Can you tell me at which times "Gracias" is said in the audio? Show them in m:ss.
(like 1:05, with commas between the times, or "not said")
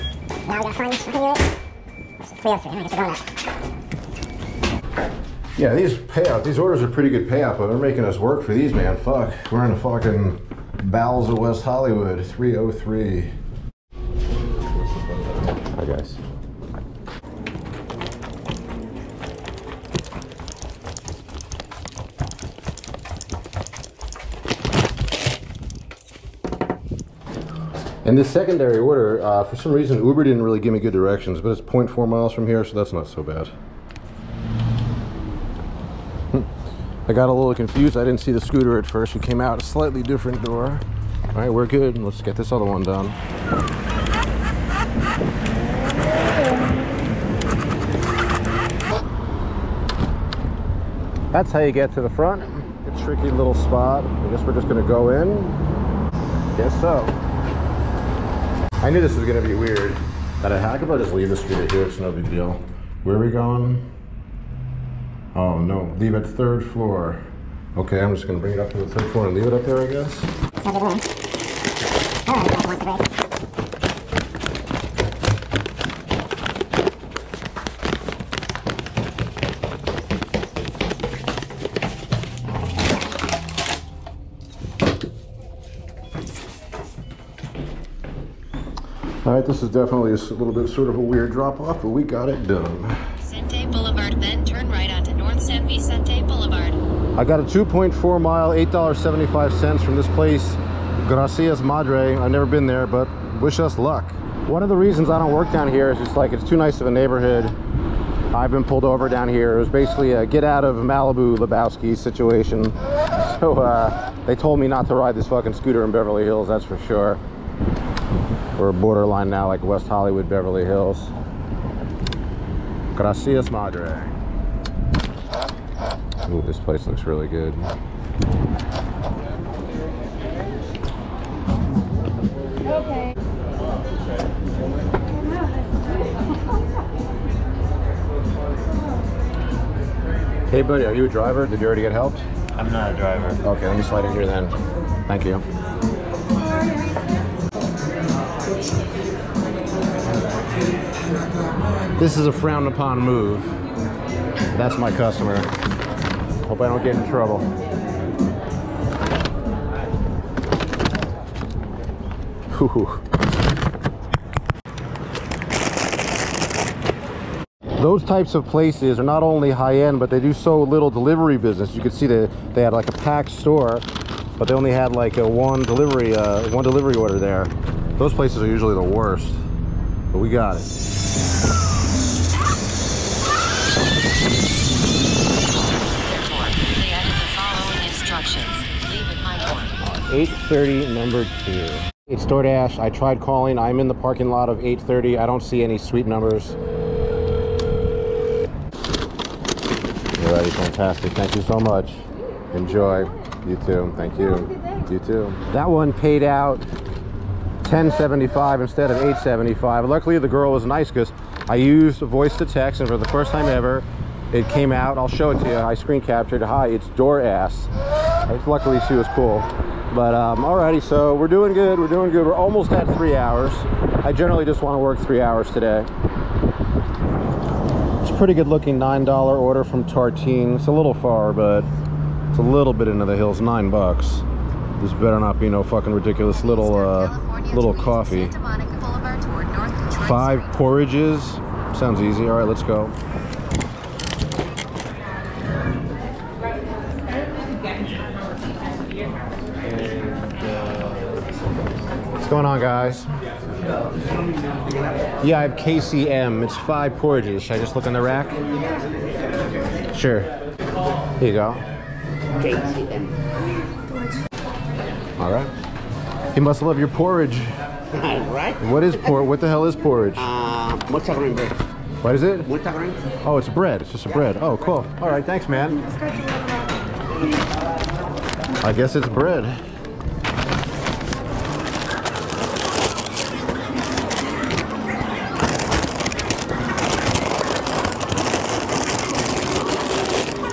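1:41, 2:02.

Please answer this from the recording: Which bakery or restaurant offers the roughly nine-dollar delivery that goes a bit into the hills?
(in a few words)
Tartine.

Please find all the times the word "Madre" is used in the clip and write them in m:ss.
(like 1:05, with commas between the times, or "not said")
1:41, 2:03.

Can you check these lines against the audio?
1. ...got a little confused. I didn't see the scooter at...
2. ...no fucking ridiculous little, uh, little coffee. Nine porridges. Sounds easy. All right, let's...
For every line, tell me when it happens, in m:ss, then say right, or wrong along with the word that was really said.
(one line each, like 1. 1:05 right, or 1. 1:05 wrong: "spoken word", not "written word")
1. 0:37 right
2. 3:55 wrong: "Five", not "Nine".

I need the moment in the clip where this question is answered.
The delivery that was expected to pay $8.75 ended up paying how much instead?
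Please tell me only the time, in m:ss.
3:27.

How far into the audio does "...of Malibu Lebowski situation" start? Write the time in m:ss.
1:50.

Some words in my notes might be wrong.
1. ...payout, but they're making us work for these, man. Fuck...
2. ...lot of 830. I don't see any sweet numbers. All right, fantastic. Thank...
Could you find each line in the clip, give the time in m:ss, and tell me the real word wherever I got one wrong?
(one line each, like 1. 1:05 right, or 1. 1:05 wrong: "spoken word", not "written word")
1. 0:07 right
2. 3:14 right.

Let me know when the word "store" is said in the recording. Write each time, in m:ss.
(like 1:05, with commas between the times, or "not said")
2:53.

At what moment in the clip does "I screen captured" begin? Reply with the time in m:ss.
3:35.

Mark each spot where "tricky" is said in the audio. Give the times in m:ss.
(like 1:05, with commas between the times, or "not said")
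0:53.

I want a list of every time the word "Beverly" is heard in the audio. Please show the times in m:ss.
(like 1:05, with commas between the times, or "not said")
1:55, 2:00.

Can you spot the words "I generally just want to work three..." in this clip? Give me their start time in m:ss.
3:44.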